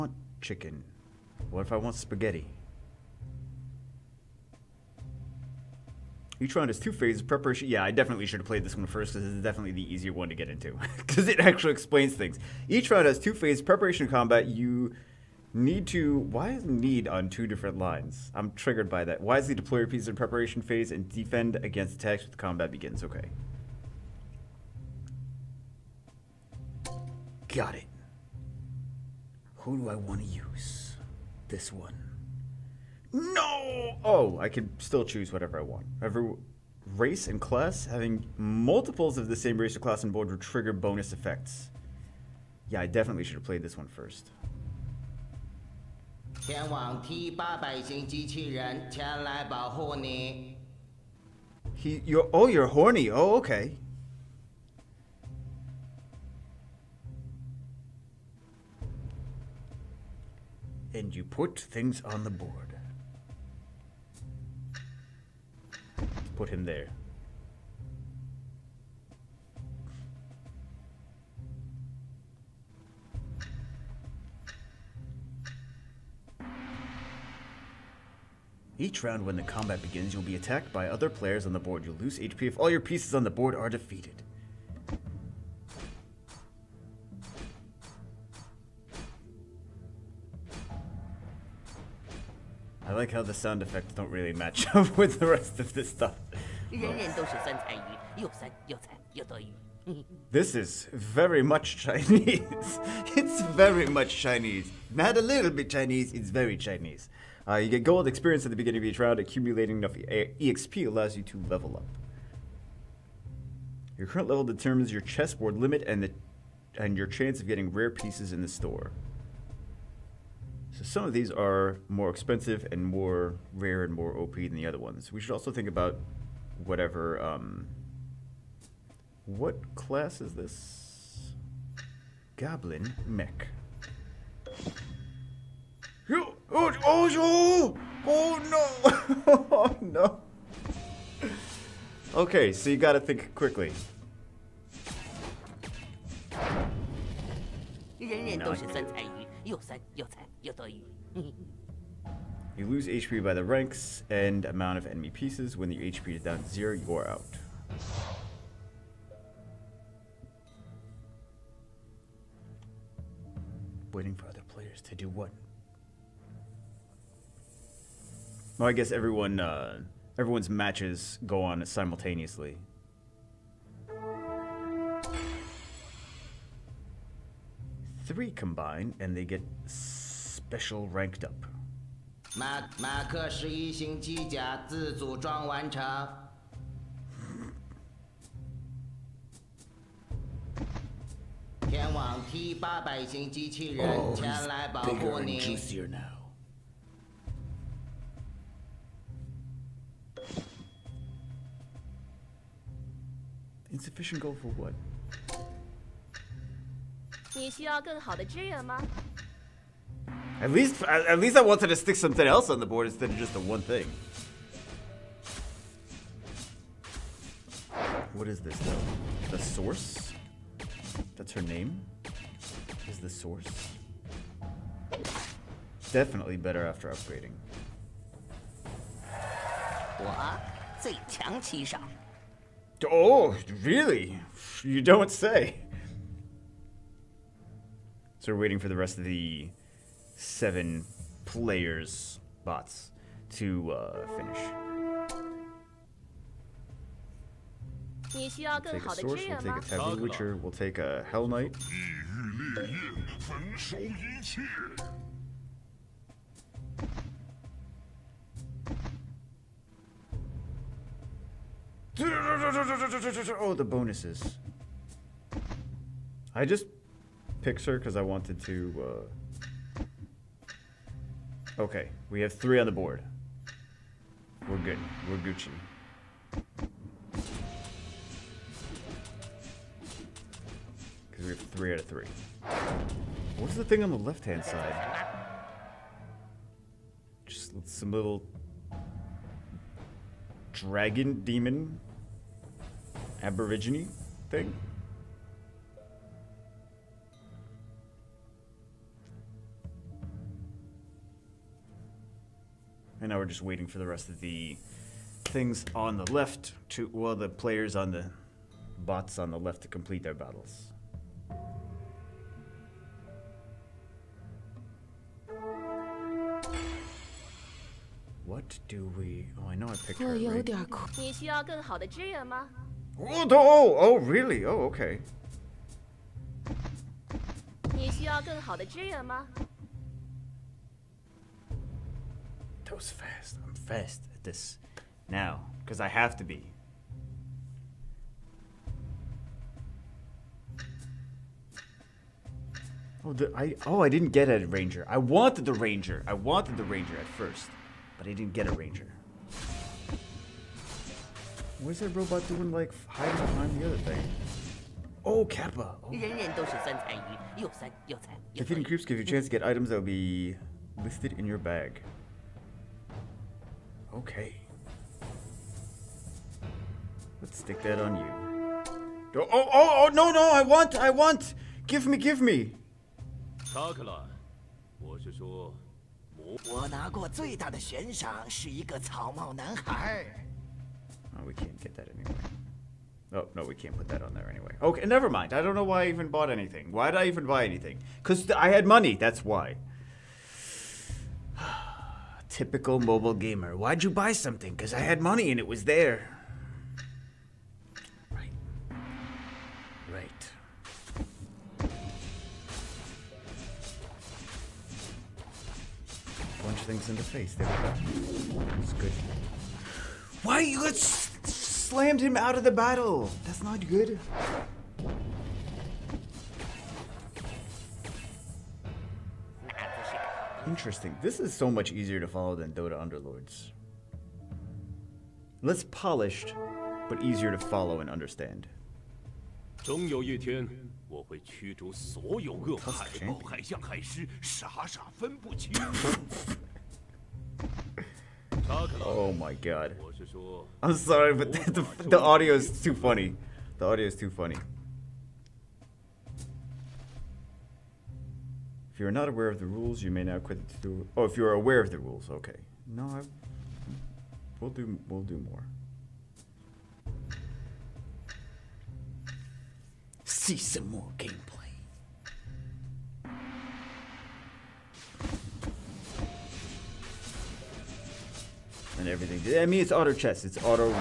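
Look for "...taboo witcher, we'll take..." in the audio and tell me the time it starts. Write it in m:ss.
4:09.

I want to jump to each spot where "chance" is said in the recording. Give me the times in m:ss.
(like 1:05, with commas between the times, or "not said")
1:57, 5:59.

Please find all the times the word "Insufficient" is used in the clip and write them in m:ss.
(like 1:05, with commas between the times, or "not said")
3:23.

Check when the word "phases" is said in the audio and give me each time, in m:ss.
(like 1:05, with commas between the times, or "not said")
0:06, 0:13, 0:20.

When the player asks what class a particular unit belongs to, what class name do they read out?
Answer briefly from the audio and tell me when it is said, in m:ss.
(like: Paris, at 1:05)
Goblin mech, at 2:12.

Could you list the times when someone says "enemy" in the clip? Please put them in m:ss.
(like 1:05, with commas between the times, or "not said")
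2:34.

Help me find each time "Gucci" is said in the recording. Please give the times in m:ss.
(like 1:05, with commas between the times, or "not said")
4:35.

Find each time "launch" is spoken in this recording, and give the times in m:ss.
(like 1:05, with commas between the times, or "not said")
not said.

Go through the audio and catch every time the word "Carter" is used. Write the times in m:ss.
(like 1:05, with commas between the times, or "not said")
not said.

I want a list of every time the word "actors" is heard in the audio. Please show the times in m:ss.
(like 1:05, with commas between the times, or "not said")
not said.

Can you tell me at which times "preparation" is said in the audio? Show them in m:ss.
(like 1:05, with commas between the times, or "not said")
0:07, 0:13, 0:20.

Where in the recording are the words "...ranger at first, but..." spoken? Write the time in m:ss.
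5:46.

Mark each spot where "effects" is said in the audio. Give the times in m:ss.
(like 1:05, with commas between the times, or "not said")
0:41, 1:33.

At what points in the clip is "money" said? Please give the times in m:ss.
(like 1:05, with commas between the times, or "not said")
6:28, 6:35.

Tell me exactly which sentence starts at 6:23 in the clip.
Oh, no, we can't put that on there anyway.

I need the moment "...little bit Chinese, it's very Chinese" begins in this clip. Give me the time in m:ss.
1:45.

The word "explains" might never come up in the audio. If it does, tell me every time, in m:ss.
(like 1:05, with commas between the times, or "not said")
0:11.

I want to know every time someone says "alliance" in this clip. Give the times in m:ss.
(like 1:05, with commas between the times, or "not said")
not said.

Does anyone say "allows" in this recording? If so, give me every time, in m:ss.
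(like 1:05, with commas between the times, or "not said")
1:50.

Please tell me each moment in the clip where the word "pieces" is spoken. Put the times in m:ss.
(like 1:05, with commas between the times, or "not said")
0:19, 1:22, 1:57, 2:35.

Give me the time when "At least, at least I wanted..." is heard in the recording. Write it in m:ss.
3:30.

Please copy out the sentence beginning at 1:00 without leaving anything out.
And you put things on the board.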